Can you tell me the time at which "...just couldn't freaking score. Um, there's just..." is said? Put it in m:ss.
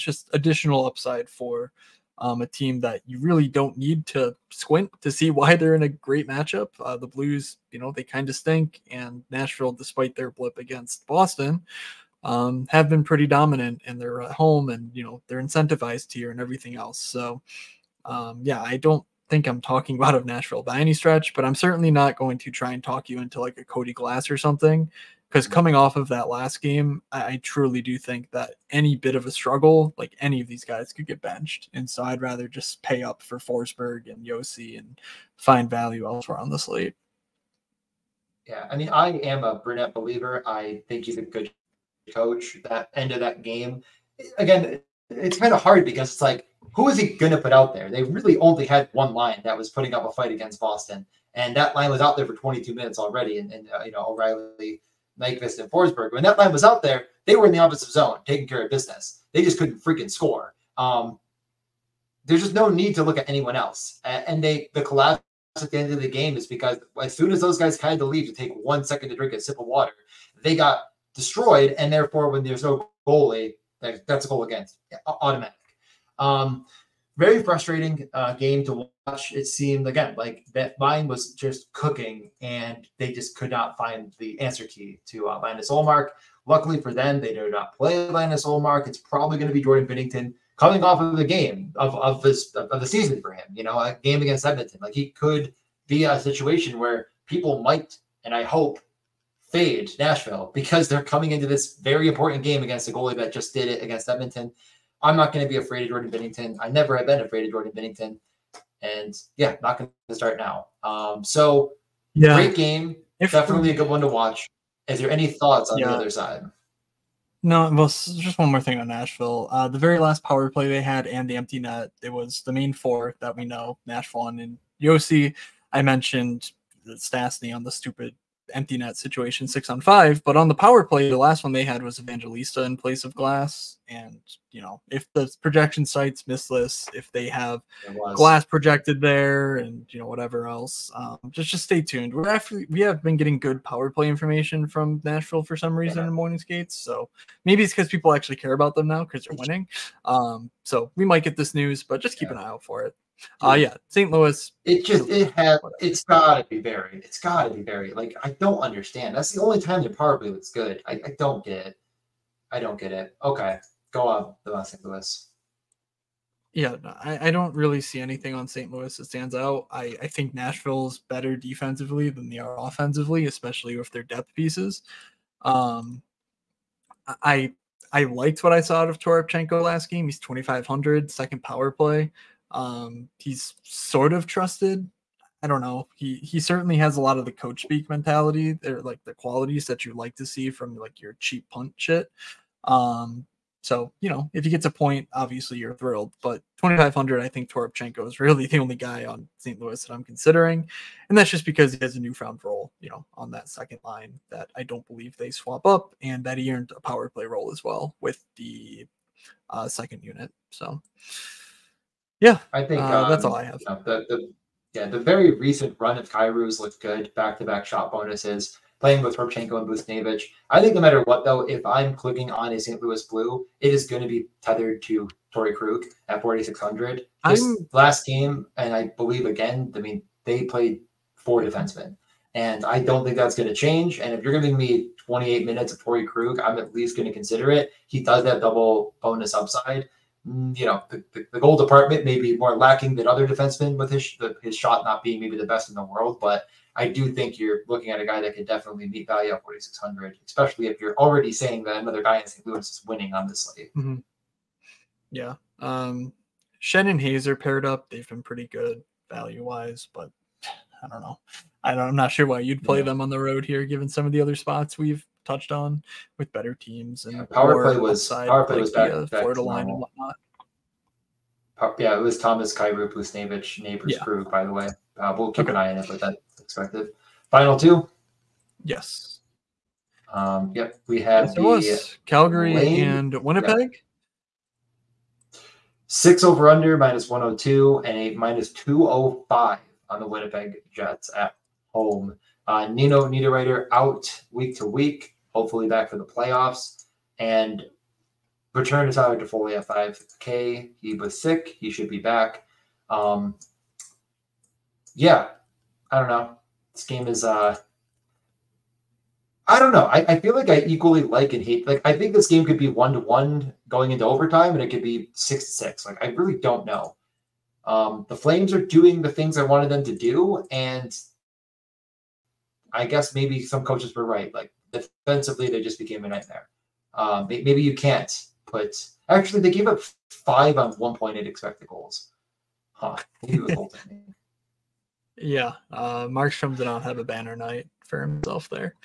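0:59.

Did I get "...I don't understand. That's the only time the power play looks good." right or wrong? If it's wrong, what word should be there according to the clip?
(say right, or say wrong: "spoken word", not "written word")
right.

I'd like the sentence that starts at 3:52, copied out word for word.
And I don't think that's going to change.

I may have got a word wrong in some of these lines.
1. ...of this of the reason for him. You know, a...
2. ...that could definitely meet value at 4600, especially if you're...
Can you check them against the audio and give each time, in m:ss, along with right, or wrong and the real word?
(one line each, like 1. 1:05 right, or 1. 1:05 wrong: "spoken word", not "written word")
1. 1:31 wrong: "season", not "reason"
2. 4:08 right.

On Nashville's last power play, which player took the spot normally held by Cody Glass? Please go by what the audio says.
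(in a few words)
Evangelista.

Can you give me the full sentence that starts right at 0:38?
Yeah, I mean, I am a Brunette believer.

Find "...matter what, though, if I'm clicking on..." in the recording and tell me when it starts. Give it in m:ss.
3:40.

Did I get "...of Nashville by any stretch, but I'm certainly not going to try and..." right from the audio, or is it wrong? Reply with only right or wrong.
right.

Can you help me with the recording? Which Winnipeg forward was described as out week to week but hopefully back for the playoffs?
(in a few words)
Nino Niederreiter.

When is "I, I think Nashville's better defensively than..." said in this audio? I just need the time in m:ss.
2:49.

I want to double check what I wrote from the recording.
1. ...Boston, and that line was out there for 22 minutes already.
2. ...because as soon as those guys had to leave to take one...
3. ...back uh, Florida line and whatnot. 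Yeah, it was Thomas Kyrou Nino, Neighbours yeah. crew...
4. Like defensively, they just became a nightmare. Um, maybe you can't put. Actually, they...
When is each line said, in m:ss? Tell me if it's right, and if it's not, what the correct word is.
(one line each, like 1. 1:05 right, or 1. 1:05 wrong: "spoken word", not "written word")
1. 0:50 right
2. 1:06 right
3. 4:29 wrong: "Buchnevich", not "Nino"
4. 5:24 right.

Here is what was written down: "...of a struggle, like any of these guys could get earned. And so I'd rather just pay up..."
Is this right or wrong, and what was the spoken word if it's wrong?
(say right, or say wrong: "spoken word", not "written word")
wrong: "benched", not "earned".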